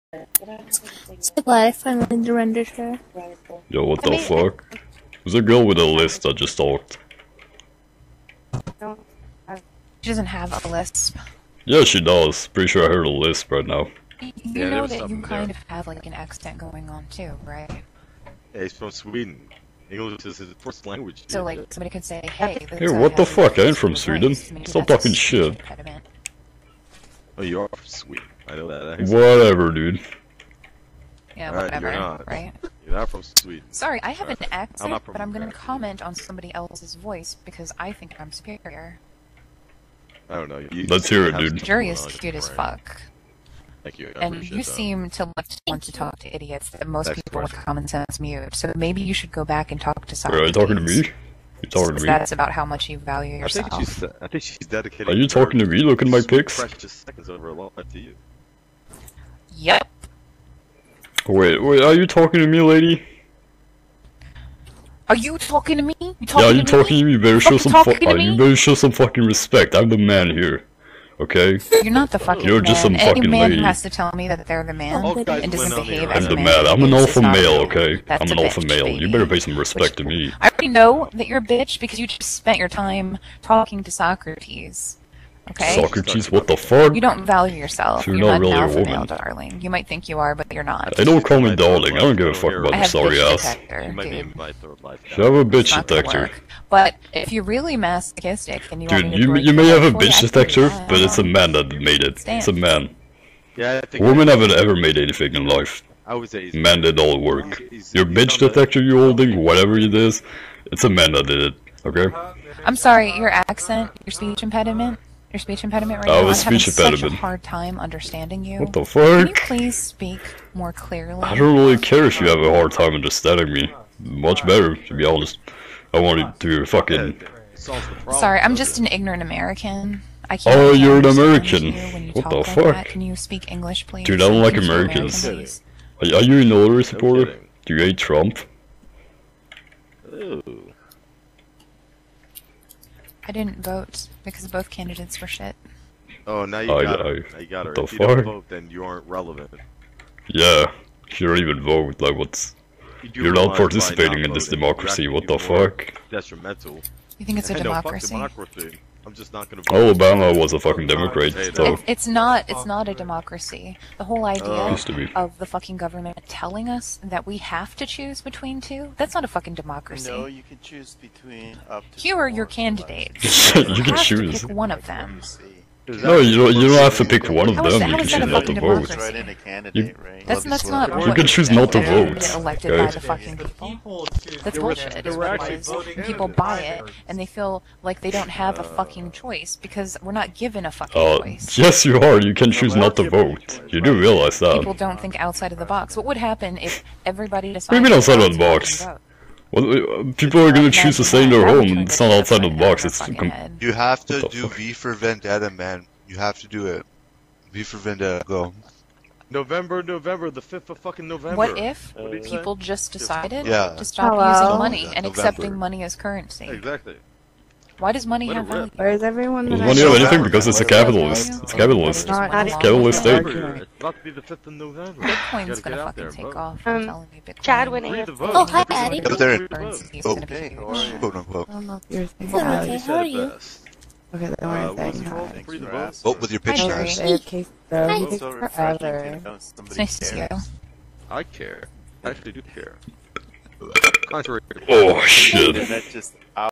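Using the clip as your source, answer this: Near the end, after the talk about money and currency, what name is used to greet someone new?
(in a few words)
Eddie.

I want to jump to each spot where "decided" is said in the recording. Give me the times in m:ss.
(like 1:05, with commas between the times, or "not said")
3:17, 3:32.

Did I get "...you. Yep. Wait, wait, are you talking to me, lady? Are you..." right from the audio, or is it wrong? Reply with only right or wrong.
right.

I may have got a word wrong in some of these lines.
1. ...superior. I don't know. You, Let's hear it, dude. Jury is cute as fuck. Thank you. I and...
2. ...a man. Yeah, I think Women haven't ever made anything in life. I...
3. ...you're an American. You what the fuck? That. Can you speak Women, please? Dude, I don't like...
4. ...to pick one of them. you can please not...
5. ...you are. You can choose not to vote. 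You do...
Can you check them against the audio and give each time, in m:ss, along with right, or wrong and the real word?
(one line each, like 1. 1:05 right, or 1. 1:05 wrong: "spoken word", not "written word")
1. 0:38 right
2. 1:42 right
3. 2:10 wrong: "English", not "Women"
4. 2:56 wrong: "choose", not "please"
5. 3:11 right.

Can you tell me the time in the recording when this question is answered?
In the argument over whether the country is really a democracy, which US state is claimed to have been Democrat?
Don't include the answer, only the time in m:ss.
2:39.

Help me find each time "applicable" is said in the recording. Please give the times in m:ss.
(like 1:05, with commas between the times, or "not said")
not said.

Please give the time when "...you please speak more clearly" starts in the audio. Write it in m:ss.
1:59.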